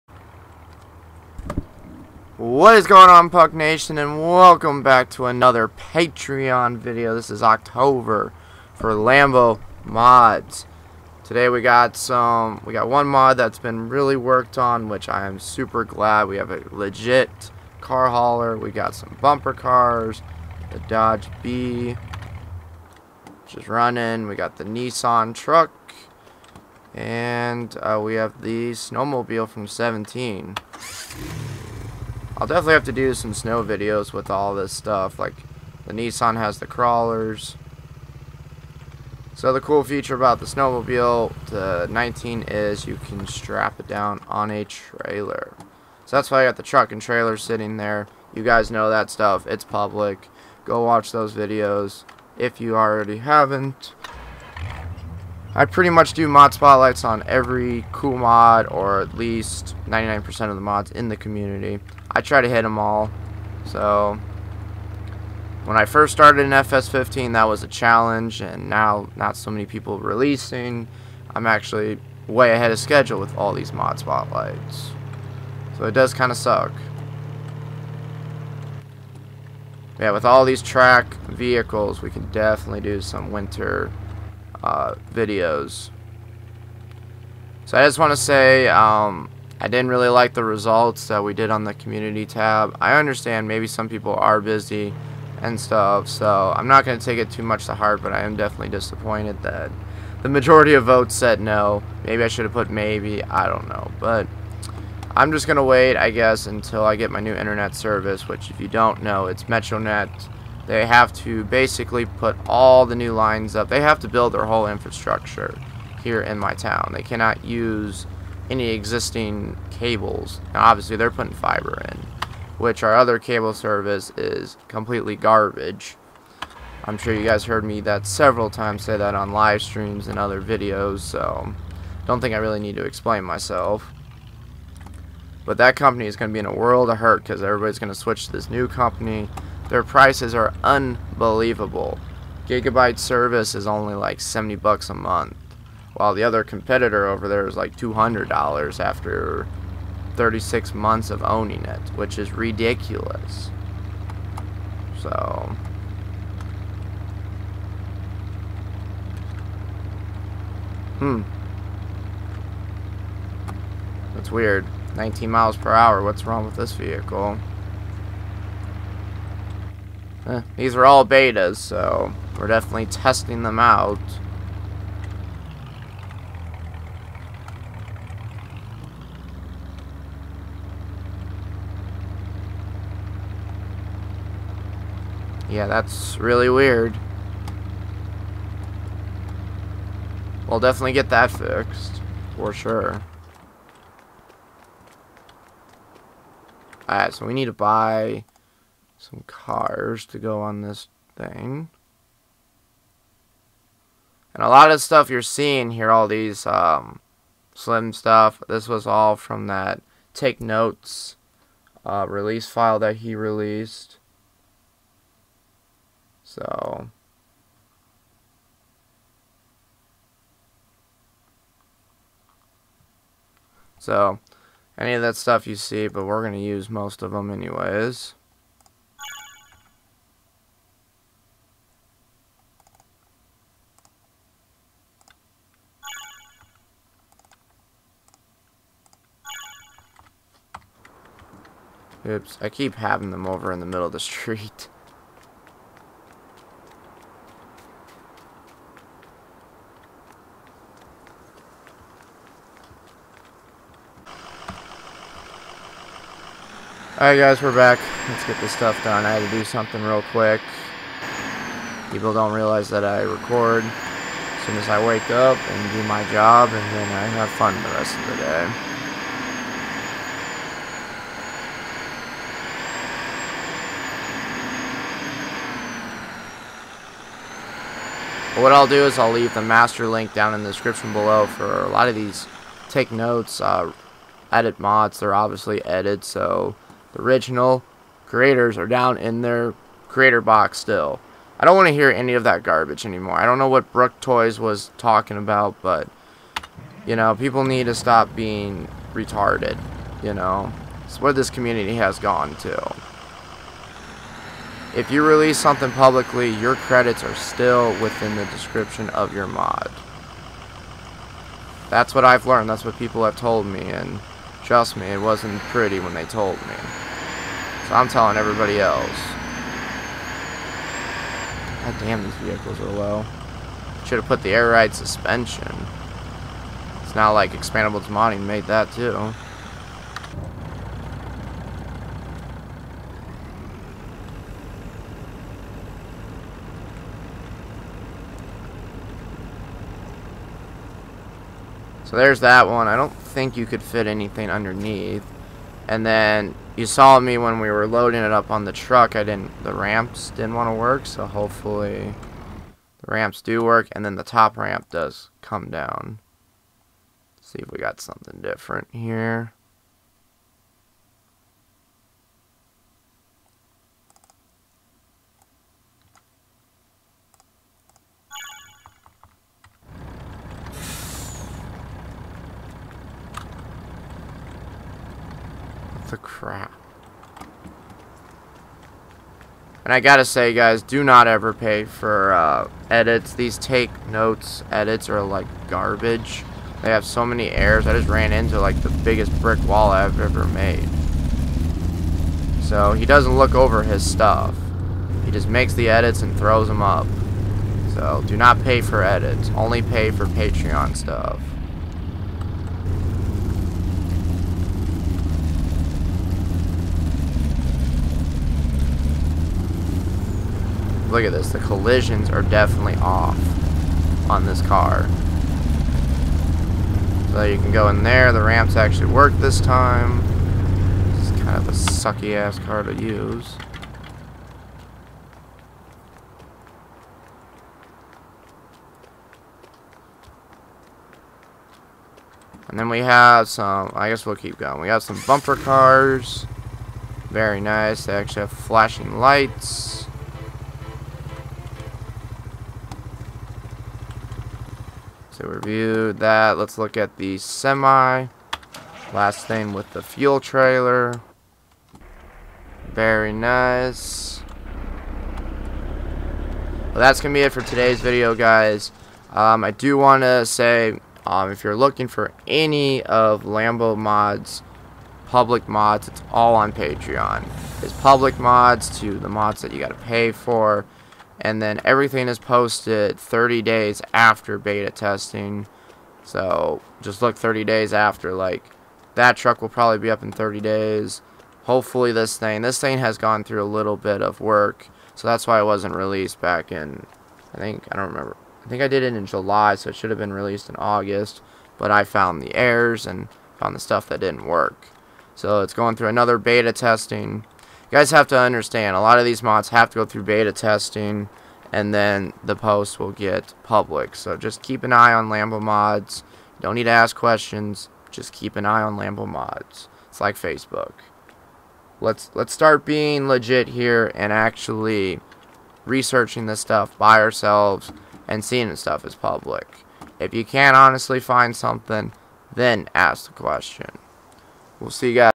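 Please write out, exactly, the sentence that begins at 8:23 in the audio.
So just keep an eye on Lambo mods.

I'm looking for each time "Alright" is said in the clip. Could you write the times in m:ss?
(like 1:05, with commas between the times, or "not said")
3:16, 4:17.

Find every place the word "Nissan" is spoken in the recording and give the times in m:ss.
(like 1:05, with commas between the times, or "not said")
0:24, 0:35.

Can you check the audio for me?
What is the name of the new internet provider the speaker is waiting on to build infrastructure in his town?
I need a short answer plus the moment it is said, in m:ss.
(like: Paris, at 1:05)
MetroNet, at 1:49.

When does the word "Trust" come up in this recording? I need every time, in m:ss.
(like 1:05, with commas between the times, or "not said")
5:14.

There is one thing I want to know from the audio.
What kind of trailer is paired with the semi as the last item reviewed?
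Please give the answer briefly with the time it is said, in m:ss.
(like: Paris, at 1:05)
fuel trailer, at 7:29.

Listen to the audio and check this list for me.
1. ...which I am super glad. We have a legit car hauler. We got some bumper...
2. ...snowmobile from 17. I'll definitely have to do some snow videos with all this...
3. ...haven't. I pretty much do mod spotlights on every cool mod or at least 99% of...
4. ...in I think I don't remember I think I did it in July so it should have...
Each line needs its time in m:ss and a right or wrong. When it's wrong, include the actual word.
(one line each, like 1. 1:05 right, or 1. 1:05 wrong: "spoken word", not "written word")
1. 0:14 right
2. 0:28 right
3. 0:53 right
4. 8:06 right.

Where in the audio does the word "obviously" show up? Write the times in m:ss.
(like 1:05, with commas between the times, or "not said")
2:00, 4:45.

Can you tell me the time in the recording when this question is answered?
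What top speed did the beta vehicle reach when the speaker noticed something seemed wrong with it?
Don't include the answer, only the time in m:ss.
2:44.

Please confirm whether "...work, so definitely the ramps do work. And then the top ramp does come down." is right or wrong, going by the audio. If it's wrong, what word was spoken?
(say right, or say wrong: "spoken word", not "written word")
wrong: "hopefully", not "definitely".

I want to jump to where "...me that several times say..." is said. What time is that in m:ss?
2:07.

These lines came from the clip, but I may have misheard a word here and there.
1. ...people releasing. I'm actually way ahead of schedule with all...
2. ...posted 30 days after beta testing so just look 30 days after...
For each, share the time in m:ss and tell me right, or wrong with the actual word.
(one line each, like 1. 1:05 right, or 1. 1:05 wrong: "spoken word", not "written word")
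1. 1:09 right
2. 7:52 right.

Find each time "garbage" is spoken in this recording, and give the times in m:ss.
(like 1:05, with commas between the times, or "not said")
2:05, 4:52, 6:25.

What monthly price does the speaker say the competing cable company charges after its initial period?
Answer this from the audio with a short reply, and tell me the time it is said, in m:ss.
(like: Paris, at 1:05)
$200, at 2:27.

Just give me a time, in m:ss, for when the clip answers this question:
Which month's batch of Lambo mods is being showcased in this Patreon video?
0:07.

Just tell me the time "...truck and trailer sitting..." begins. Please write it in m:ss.
0:46.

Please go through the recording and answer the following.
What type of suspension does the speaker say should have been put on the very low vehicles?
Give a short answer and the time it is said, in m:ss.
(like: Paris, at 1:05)
air ride suspension, at 5:24.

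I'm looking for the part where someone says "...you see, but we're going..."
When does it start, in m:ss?
3:45.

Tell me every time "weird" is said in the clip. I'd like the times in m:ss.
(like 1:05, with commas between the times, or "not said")
2:44, 3:06.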